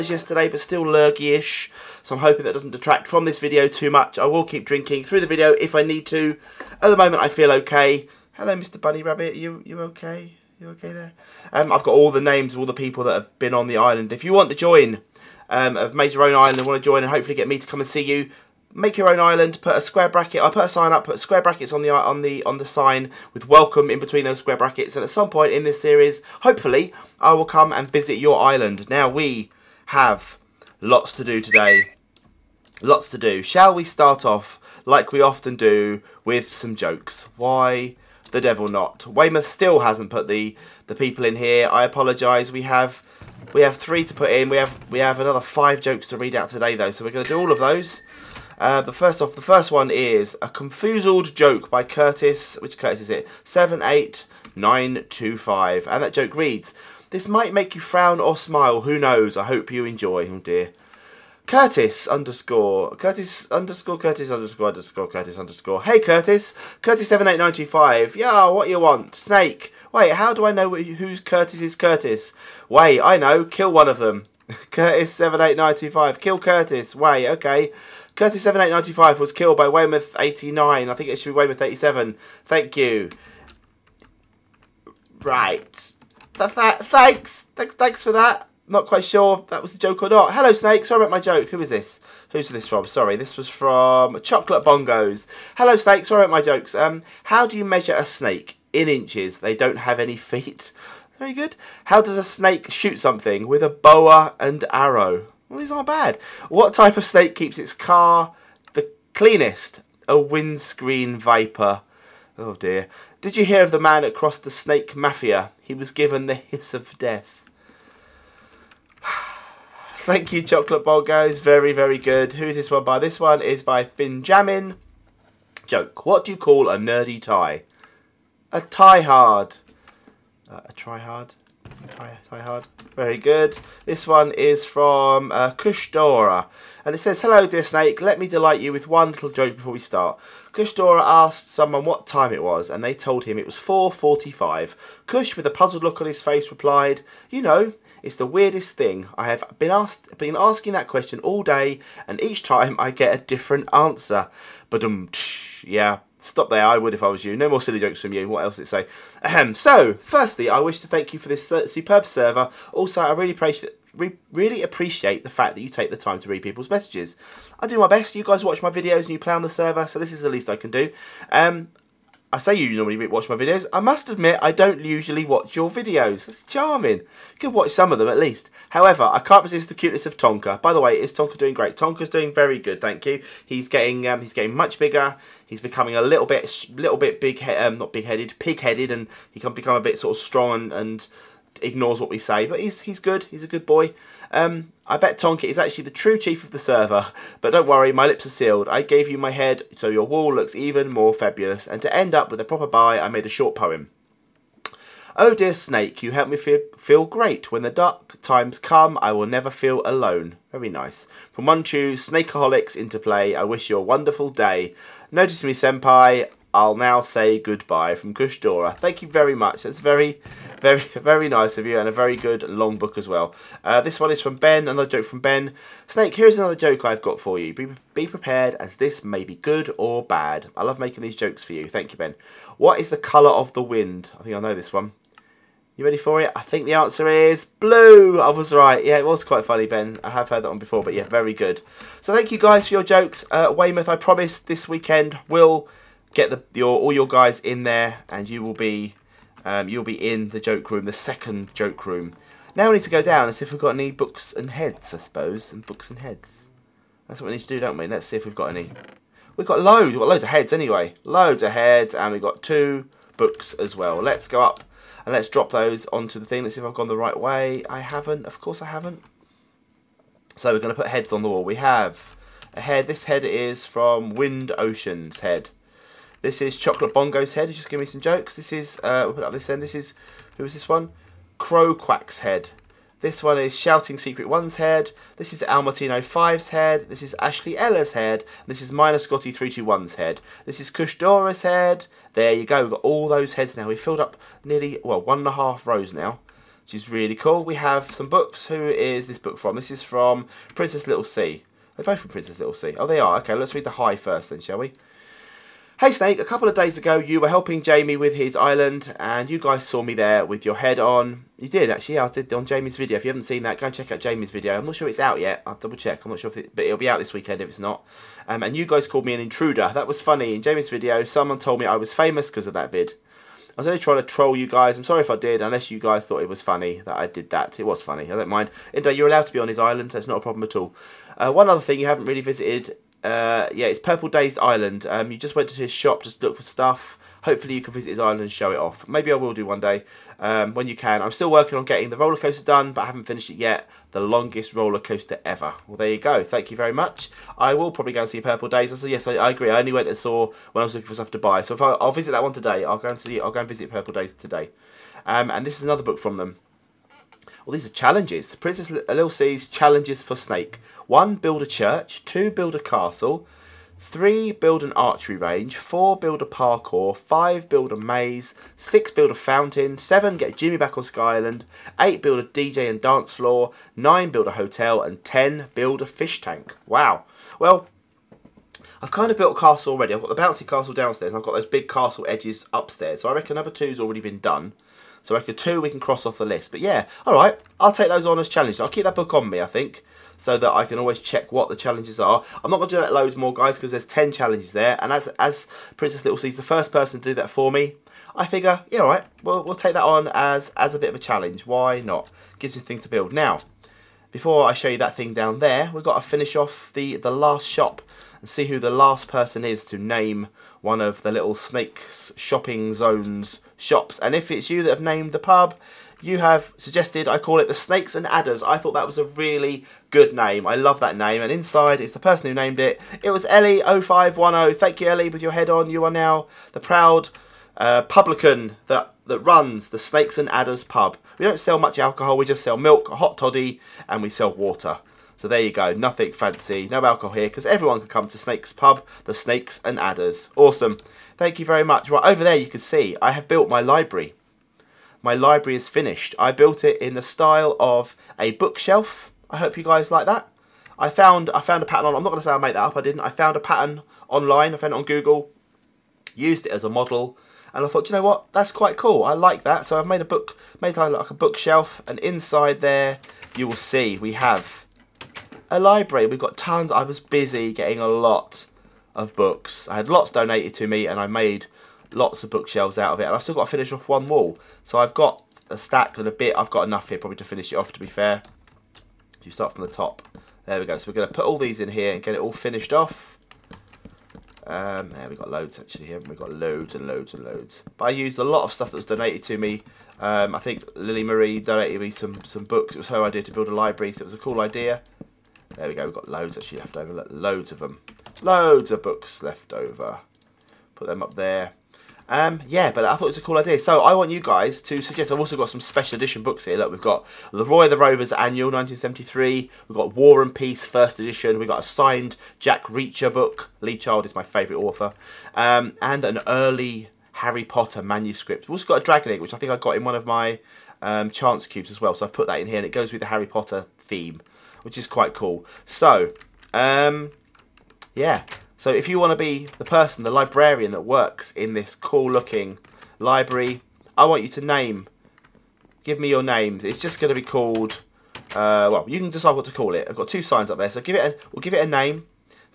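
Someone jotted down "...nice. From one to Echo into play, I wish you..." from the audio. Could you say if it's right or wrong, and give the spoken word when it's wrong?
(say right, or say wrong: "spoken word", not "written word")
wrong: "Snakeaholics", not "Echo".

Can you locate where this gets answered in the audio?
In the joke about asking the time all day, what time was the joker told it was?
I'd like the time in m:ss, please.
2:23.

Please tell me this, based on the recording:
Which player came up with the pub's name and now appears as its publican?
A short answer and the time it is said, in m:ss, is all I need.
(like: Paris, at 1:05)
Ellie0510, at 7:03.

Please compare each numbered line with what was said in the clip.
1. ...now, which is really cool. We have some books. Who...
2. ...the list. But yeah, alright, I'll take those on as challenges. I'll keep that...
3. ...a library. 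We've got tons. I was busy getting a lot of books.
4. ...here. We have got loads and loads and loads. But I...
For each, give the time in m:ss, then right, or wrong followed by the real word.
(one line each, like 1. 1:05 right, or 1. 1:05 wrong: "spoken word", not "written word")
1. 4:55 right
2. 6:26 right
3. 7:45 right
4. 8:05 right.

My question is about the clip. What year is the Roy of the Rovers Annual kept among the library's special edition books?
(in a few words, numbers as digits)
1973.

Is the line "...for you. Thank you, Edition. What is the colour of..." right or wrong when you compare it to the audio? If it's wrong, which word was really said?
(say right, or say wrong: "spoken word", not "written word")
wrong: "Ben", not "Edition".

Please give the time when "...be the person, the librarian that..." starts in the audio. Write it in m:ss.
8:49.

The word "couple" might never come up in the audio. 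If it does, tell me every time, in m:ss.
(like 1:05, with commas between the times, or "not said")
5:06.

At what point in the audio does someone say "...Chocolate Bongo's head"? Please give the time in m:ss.
4:36.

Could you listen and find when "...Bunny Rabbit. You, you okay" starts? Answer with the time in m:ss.
0:08.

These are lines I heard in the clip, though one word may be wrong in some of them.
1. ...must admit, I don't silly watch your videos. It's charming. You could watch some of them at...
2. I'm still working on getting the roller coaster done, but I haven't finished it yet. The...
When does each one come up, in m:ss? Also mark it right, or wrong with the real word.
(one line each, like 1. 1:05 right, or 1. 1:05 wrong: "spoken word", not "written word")
1. 2:53 wrong: "usually", not "silly"
2. 5:41 right.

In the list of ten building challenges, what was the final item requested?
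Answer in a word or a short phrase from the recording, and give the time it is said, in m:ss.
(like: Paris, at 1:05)
A fish tank, at 6:15.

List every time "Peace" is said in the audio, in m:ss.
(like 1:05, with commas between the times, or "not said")
8:30.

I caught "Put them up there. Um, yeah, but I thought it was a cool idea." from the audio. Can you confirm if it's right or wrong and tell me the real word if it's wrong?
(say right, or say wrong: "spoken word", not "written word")
right.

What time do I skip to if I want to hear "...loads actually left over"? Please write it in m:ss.
8:16.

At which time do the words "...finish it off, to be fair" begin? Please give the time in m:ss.
7:57.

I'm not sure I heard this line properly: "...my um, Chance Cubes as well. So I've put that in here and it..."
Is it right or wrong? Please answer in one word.
right.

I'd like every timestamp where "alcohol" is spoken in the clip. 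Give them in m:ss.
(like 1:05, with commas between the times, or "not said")
7:11, 7:16.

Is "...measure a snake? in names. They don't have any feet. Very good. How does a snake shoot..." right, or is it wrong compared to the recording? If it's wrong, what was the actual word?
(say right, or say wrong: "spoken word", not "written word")
wrong: "inches", not "names".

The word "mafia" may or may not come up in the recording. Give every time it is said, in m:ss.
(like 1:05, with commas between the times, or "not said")
1:54.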